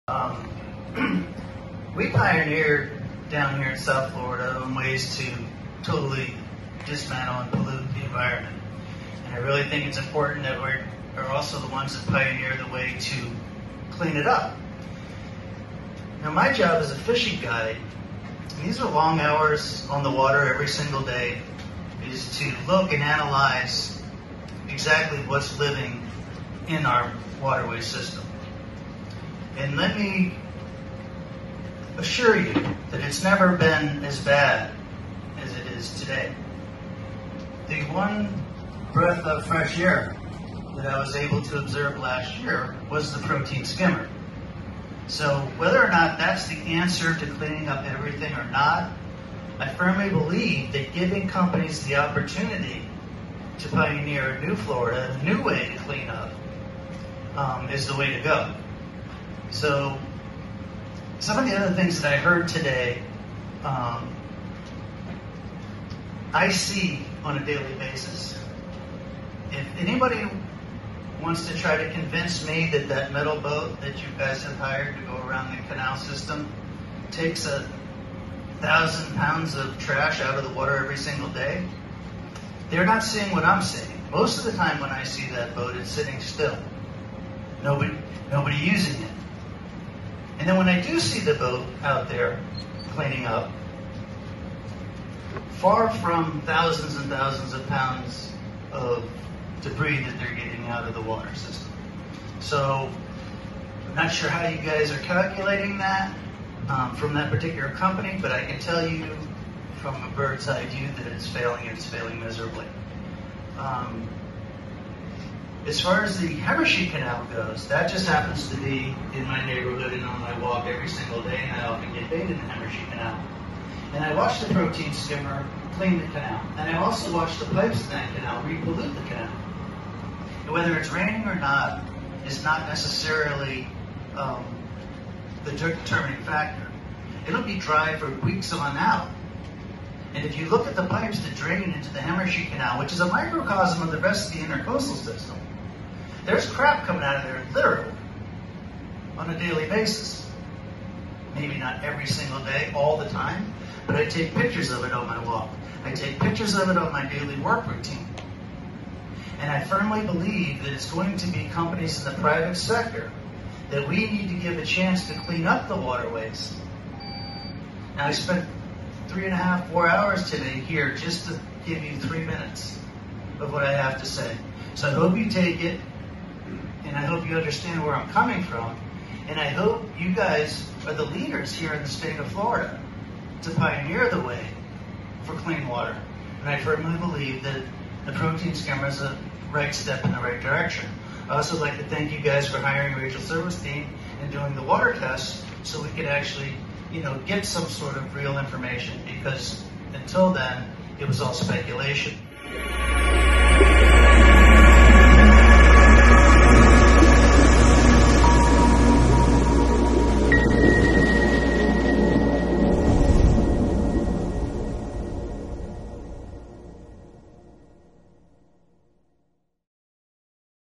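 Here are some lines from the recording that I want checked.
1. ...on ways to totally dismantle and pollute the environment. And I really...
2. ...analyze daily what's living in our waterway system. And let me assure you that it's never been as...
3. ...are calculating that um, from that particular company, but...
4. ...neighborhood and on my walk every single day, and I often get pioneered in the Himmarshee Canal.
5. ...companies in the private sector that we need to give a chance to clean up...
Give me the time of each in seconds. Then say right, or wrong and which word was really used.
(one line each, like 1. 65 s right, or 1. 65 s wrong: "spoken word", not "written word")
1. 4 s right
2. 23 s wrong: "exactly", not "daily"
3. 104 s right
4. 119 s wrong: "bathed", not "pioneered"
5. 161 s right.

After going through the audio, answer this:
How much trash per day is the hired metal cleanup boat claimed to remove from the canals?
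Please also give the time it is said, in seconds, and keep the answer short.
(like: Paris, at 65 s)
1,000 pounds, at 77 s.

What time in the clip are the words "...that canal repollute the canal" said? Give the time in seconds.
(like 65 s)
127 s.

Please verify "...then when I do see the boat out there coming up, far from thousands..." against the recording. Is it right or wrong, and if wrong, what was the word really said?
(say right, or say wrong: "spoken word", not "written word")
wrong: "cleaning", not "coming".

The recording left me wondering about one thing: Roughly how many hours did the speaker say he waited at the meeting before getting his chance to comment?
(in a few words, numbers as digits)
3.5 to 4 hours.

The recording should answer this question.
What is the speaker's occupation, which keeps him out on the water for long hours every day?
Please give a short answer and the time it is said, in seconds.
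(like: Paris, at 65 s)
fishing guide, at 16 s.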